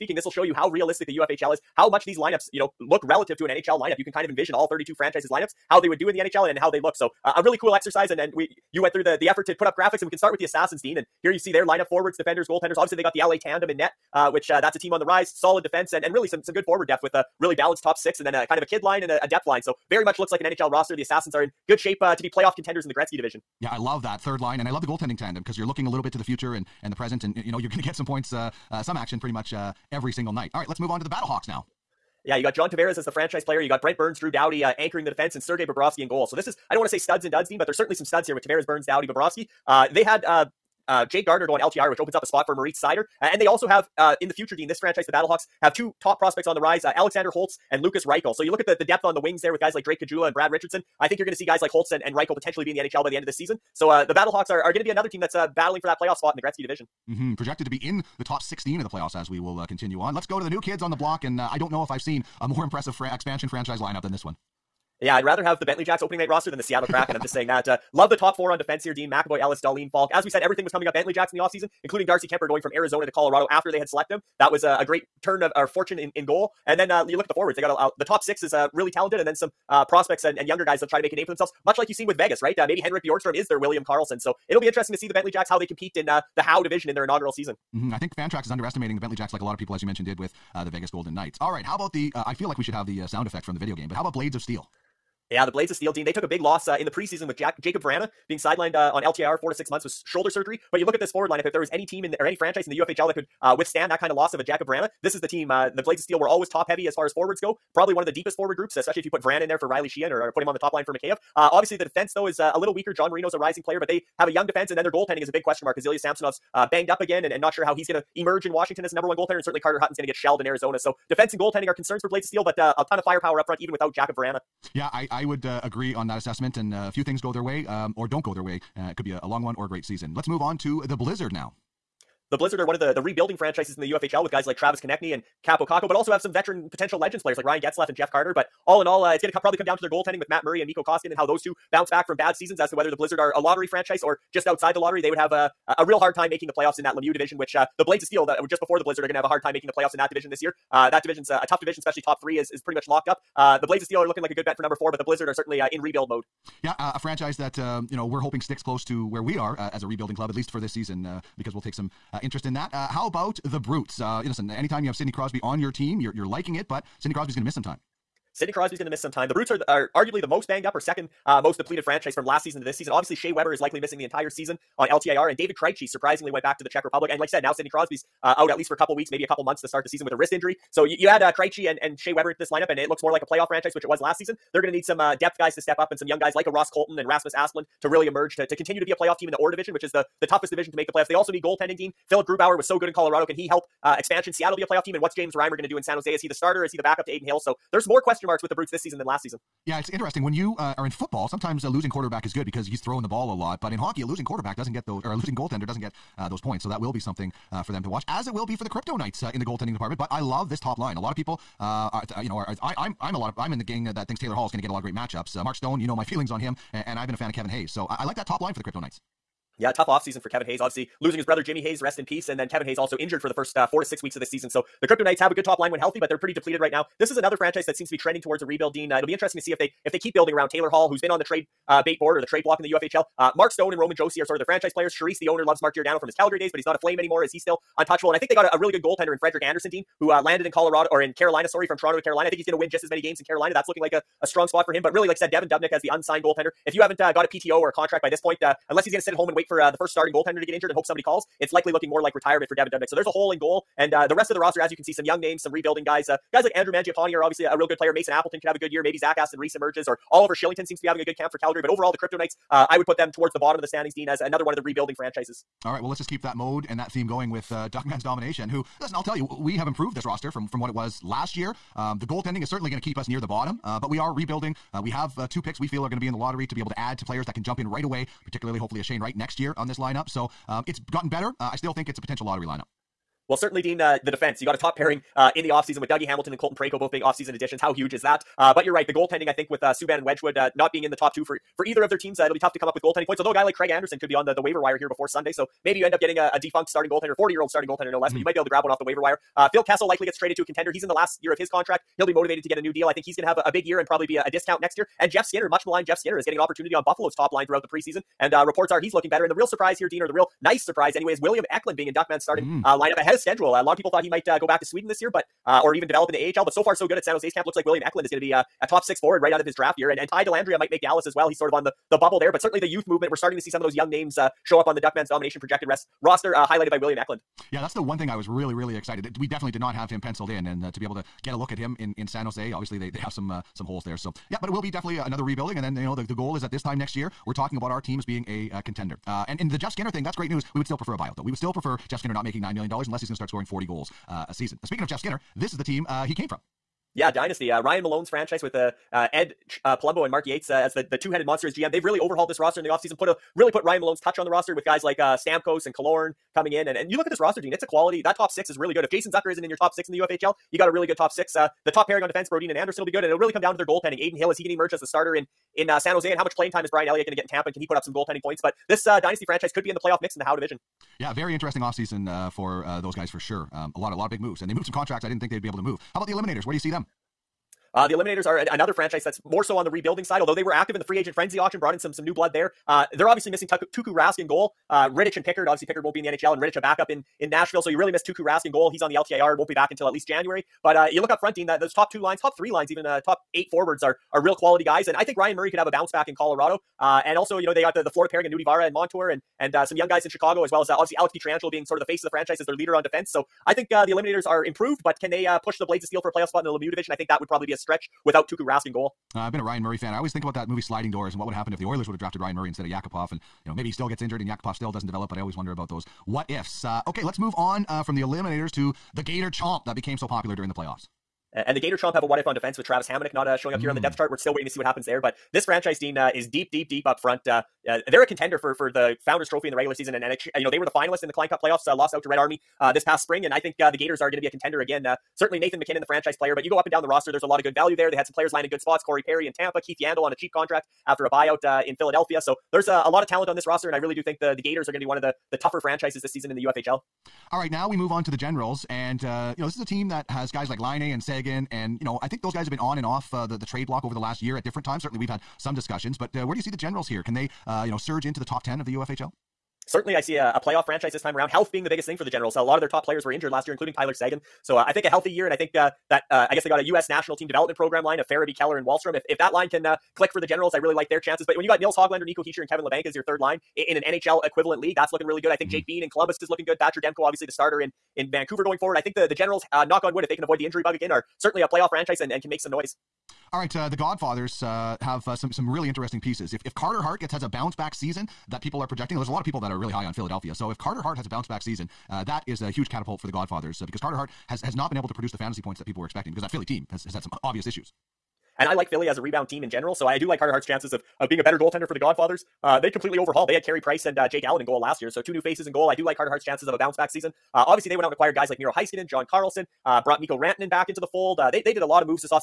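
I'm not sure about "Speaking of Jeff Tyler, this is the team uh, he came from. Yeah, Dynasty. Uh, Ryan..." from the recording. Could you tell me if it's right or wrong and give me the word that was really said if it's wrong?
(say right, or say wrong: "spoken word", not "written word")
wrong: "Skinner", not "Tyler".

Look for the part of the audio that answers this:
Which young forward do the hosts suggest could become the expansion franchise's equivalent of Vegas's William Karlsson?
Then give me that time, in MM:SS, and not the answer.
01:22.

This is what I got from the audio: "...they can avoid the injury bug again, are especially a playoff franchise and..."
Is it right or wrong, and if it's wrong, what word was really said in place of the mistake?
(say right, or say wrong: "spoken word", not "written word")
wrong: "certainly", not "especially".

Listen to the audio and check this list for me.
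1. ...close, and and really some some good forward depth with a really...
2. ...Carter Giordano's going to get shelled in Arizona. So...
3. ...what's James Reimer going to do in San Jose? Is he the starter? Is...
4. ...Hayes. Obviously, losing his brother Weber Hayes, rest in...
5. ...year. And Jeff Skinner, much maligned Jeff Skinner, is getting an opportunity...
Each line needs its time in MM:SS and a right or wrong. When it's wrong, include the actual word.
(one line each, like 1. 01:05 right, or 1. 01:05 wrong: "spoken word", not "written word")
1. 00:15 wrong: "defense", not "close"
2. 01:59 wrong: "Hutton", not "Giordano"
3. 03:15 right
4. 03:40 wrong: "Jimmy", not "Weber"
5. 05:04 right.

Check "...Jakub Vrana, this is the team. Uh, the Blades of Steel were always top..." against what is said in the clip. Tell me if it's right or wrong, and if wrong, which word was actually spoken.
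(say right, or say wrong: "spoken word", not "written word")
right.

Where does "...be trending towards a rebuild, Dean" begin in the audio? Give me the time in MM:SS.
03:47.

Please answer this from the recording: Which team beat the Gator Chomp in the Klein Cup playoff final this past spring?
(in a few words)
Red Army.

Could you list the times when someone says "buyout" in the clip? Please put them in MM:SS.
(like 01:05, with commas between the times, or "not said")
05:40, 07:21.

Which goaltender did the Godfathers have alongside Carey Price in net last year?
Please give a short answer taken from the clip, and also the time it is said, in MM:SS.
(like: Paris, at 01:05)
Jake Allen, at 08:24.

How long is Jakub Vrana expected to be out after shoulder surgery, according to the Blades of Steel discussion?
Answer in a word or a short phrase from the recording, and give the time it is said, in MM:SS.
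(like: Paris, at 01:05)
4 to 6 months, at 01:39.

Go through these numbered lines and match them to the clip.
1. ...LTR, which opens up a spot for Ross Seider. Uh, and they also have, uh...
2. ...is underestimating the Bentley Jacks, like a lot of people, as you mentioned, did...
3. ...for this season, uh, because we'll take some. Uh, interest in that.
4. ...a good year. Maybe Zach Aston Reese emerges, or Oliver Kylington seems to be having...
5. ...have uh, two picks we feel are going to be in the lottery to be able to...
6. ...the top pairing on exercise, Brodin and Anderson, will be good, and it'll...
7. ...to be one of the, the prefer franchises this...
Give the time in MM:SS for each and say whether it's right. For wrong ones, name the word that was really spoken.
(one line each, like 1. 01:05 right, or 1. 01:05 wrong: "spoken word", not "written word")
1. 00:41 wrong: "Moritz", not "Ross"
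2. 01:28 right
3. 02:40 right
4. 04:18 right
5. 04:34 right
6. 06:01 wrong: "defense", not "exercise"
7. 07:24 wrong: "tougher", not "prefer".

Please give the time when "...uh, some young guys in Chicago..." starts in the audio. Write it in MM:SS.
06:39.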